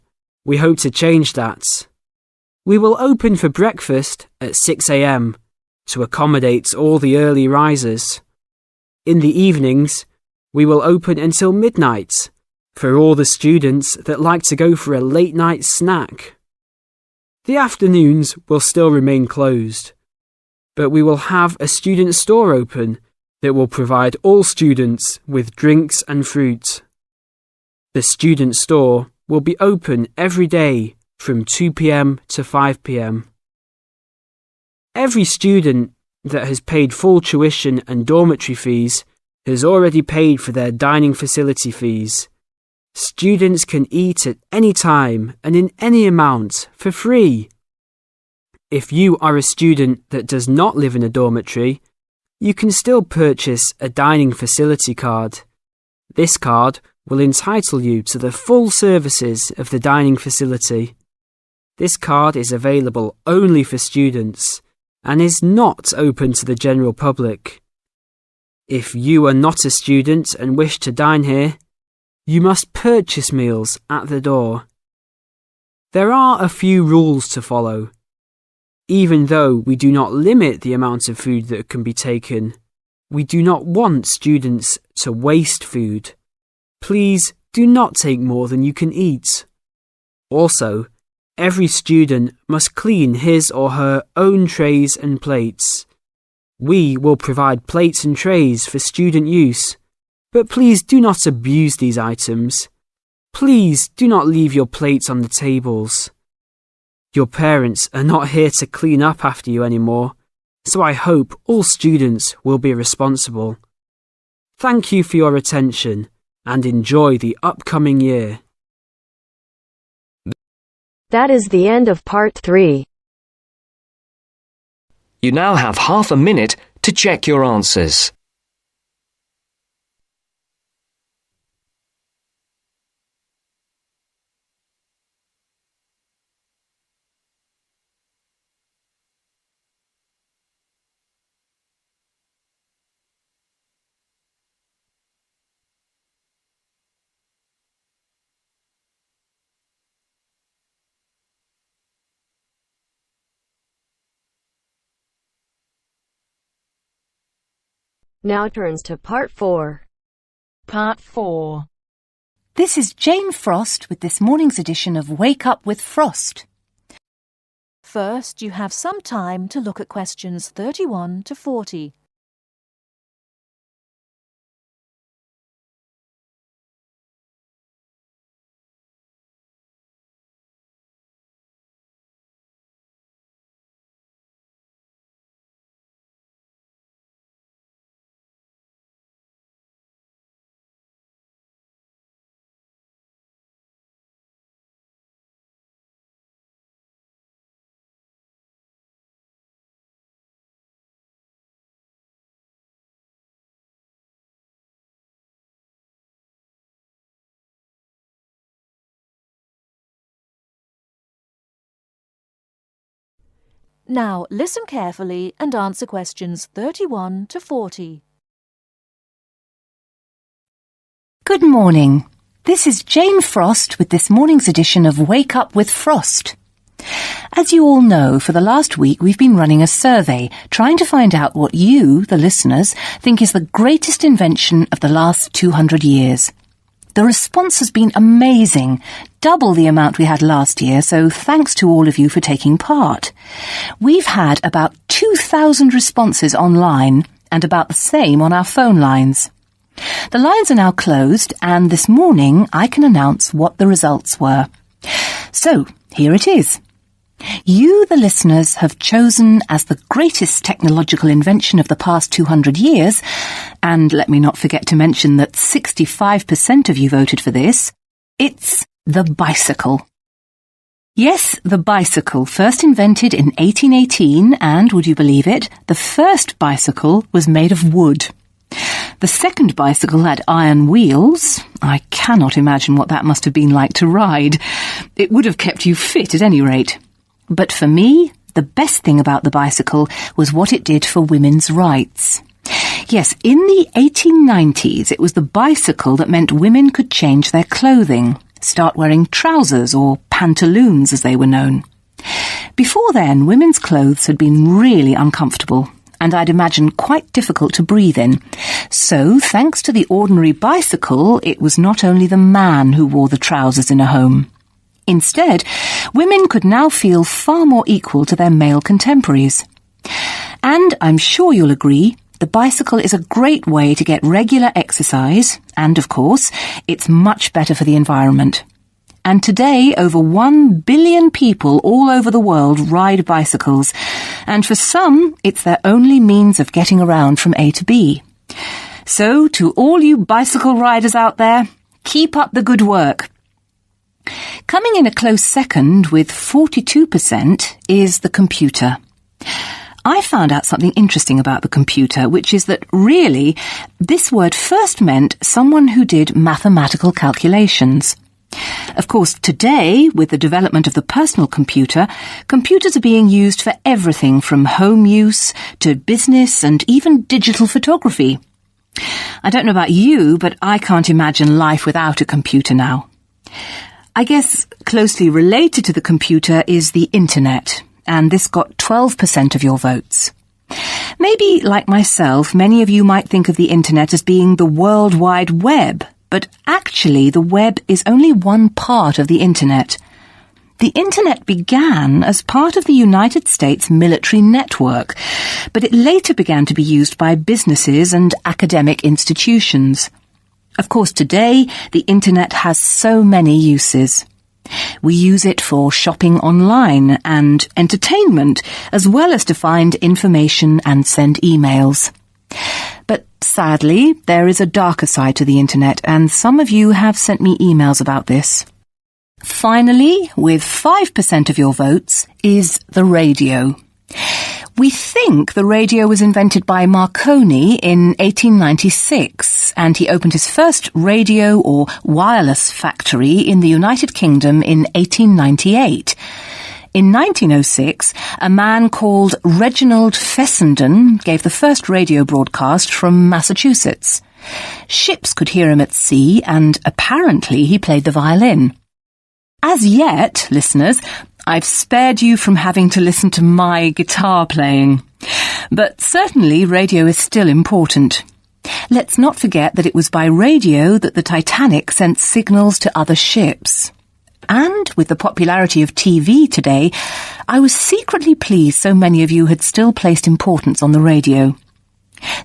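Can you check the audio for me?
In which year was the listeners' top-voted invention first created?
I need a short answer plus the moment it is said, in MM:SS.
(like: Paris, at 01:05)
1818, at 04:33.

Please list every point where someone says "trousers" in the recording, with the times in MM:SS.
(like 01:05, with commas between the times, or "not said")
04:59, 05:13.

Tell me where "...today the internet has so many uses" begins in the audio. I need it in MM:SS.
06:40.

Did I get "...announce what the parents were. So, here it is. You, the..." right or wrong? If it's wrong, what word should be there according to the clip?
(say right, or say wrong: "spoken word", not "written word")
wrong: "results", not "parents".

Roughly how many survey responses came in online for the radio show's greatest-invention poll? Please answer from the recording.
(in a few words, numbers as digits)
2,000.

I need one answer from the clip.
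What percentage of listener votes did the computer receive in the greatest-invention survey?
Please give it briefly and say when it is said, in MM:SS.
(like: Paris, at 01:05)
42%, at 05:46.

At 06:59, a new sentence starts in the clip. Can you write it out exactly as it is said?
Finally, with 5% of your votes, is the radio.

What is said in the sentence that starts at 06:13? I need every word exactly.
I guess closely related to the computer is the internet, and this got 12% of your votes.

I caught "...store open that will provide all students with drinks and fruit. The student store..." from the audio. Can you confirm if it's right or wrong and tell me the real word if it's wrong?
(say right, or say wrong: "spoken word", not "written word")
right.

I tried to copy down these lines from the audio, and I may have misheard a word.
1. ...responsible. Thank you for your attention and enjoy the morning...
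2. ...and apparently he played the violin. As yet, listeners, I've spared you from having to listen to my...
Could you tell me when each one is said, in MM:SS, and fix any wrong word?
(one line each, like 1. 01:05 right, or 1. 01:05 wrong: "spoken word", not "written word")
1. 01:52 wrong: "upcoming", not "morning"
2. 07:26 right.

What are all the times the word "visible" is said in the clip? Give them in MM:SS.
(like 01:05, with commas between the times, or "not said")
not said.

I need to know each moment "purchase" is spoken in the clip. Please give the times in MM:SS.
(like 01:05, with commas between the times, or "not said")
00:53, 01:12.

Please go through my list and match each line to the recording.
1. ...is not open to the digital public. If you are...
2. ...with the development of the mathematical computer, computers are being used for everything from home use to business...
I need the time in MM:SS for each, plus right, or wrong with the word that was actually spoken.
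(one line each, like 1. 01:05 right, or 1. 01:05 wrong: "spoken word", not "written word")
1. 01:05 wrong: "general", not "digital"
2. 05:59 wrong: "personal", not "mathematical".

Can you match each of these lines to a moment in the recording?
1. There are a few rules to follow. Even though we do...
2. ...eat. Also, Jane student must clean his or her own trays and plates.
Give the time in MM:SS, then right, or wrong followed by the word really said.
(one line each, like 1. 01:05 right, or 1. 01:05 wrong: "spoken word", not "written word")
1. 01:15 right
2. 01:28 wrong: "Every", not "Jane".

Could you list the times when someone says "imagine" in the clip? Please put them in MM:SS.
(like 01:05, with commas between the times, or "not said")
04:42, 05:06, 06:10.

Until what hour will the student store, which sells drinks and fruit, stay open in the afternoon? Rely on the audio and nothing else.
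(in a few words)
5 pm.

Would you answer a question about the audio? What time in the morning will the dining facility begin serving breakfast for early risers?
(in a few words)
6am.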